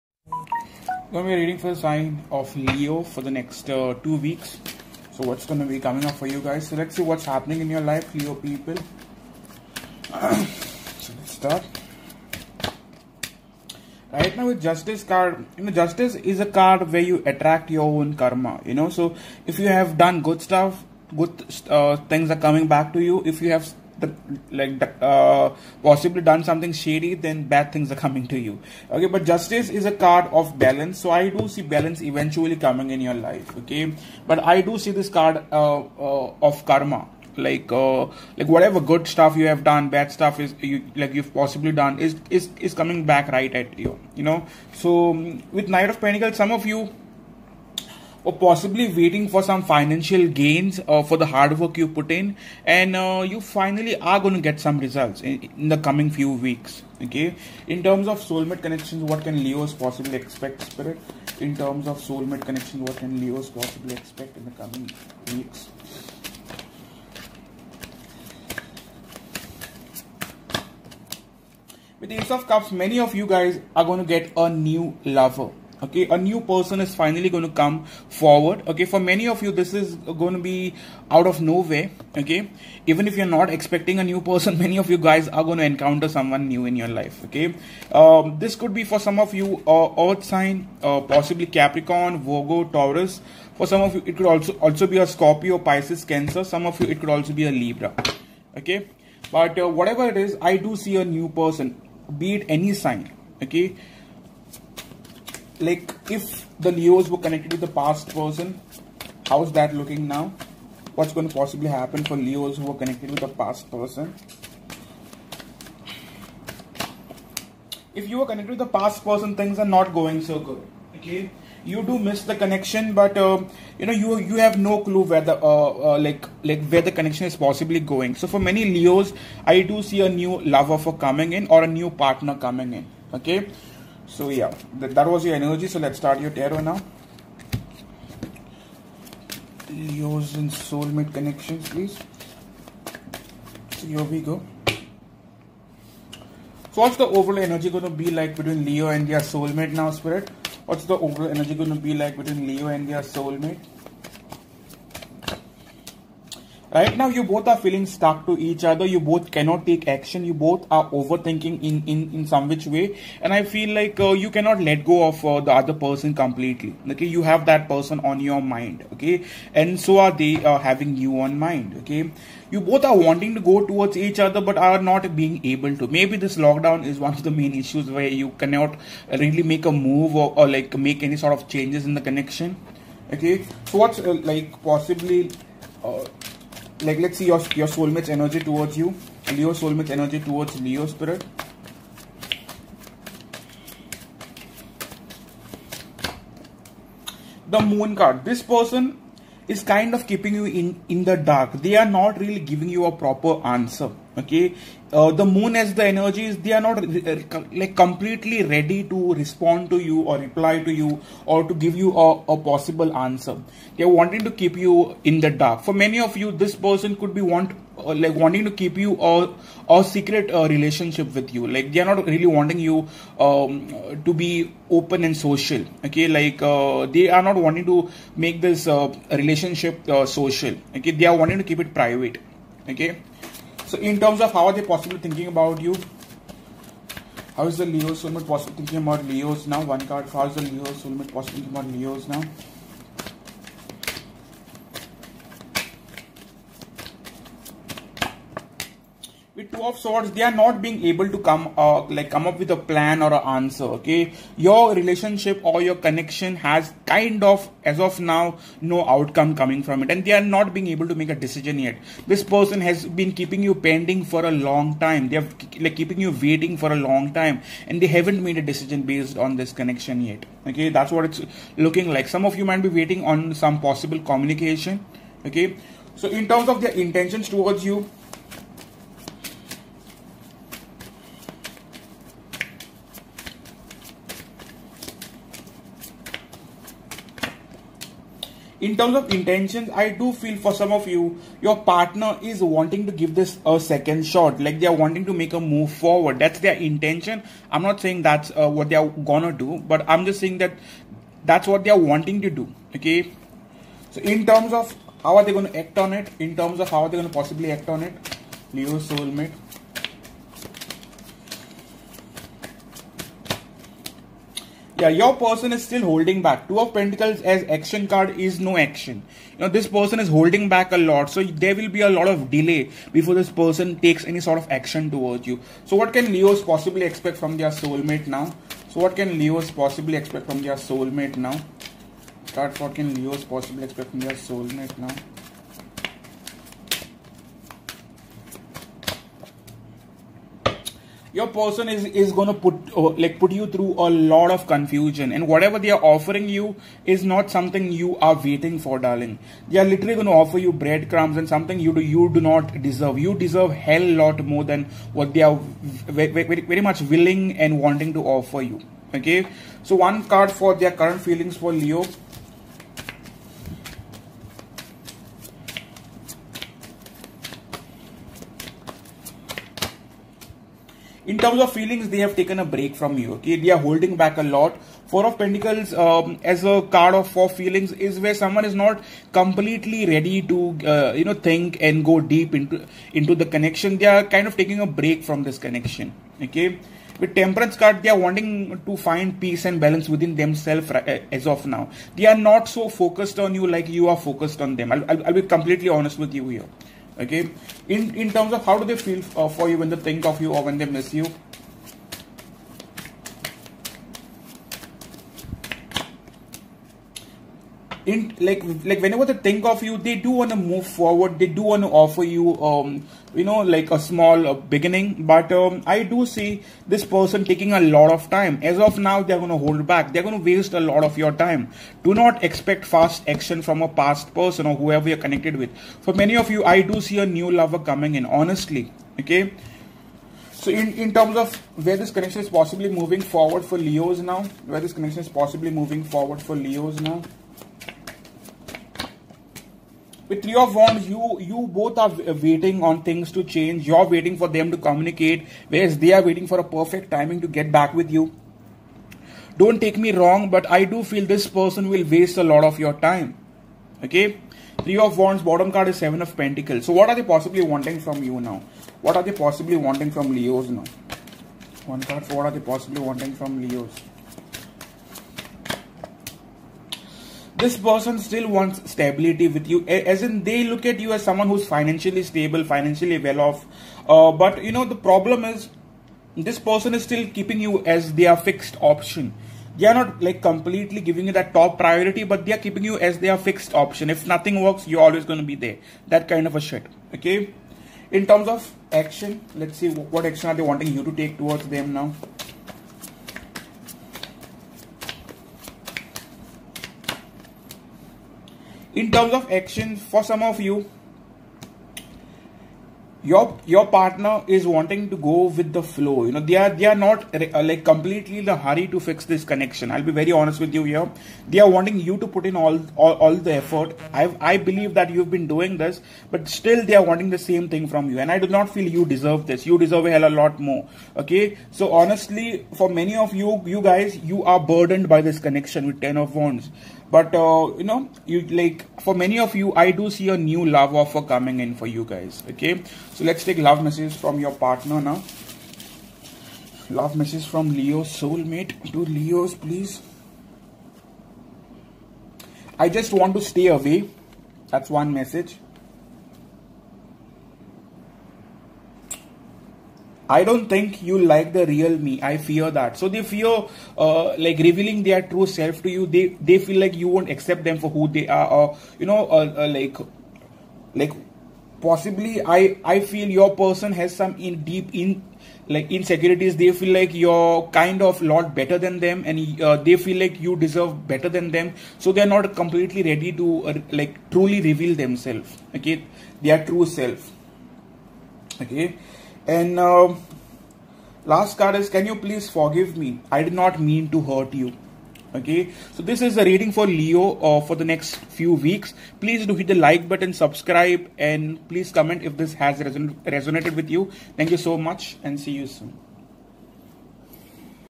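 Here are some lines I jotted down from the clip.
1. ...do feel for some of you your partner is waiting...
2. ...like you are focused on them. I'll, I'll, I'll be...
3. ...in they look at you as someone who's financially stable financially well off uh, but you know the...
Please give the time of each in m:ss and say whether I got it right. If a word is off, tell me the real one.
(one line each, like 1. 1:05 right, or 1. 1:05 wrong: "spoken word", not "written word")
1. 4:50 wrong: "wanting", not "waiting"
2. 6:33 right
3. 7:50 right.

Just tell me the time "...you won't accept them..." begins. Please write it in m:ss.
9:16.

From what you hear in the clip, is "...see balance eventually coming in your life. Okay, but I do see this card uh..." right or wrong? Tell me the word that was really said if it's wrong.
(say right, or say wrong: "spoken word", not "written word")
right.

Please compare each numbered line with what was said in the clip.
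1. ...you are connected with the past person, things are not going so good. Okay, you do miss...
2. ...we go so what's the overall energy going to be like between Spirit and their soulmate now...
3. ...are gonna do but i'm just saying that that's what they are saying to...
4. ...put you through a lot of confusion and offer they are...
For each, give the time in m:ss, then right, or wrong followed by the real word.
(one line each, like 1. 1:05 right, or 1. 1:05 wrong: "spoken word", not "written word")
1. 1:58 right
2. 2:24 wrong: "Leo", not "Spirit"
3. 4:58 wrong: "wanting", not "saying"
4. 5:43 wrong: "whatever", not "offer".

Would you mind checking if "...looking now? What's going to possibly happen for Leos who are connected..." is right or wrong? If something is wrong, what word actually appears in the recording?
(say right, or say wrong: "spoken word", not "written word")
right.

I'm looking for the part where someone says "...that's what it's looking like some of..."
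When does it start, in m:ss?
4:30.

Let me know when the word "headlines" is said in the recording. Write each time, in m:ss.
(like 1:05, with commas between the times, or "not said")
not said.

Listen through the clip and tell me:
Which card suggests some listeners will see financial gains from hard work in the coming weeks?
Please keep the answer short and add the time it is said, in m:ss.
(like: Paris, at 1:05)
Knight of Pentacles, at 0:45.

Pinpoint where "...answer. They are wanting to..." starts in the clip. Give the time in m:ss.
3:33.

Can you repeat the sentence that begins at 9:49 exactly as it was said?
Please do hit the like button, subscribe, and please comment if this has reson resonated with you.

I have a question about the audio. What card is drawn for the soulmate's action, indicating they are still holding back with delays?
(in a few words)
Two of Pentacles.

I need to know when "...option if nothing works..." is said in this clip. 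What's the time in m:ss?
8:03.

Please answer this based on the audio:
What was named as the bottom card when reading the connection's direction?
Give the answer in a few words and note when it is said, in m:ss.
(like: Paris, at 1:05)
Seven of Pentacles, at 7:35.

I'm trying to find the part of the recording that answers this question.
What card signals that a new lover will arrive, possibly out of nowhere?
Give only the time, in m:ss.
1:12.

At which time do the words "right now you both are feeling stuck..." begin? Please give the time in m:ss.
2:36.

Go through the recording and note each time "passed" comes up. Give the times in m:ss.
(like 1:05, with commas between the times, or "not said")
not said.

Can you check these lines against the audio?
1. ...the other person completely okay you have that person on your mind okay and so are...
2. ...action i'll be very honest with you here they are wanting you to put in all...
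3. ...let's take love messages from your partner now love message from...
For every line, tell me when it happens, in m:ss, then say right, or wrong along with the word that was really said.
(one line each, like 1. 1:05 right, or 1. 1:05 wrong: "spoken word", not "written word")
1. 2:45 right
2. 8:29 wrong: "connection", not "action"
3. 8:53 right.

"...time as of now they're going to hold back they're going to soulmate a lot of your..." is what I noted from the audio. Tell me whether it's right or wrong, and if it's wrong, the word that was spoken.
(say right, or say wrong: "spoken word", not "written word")
wrong: "waste", not "soulmate".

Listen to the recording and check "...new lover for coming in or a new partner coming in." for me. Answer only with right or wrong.
right.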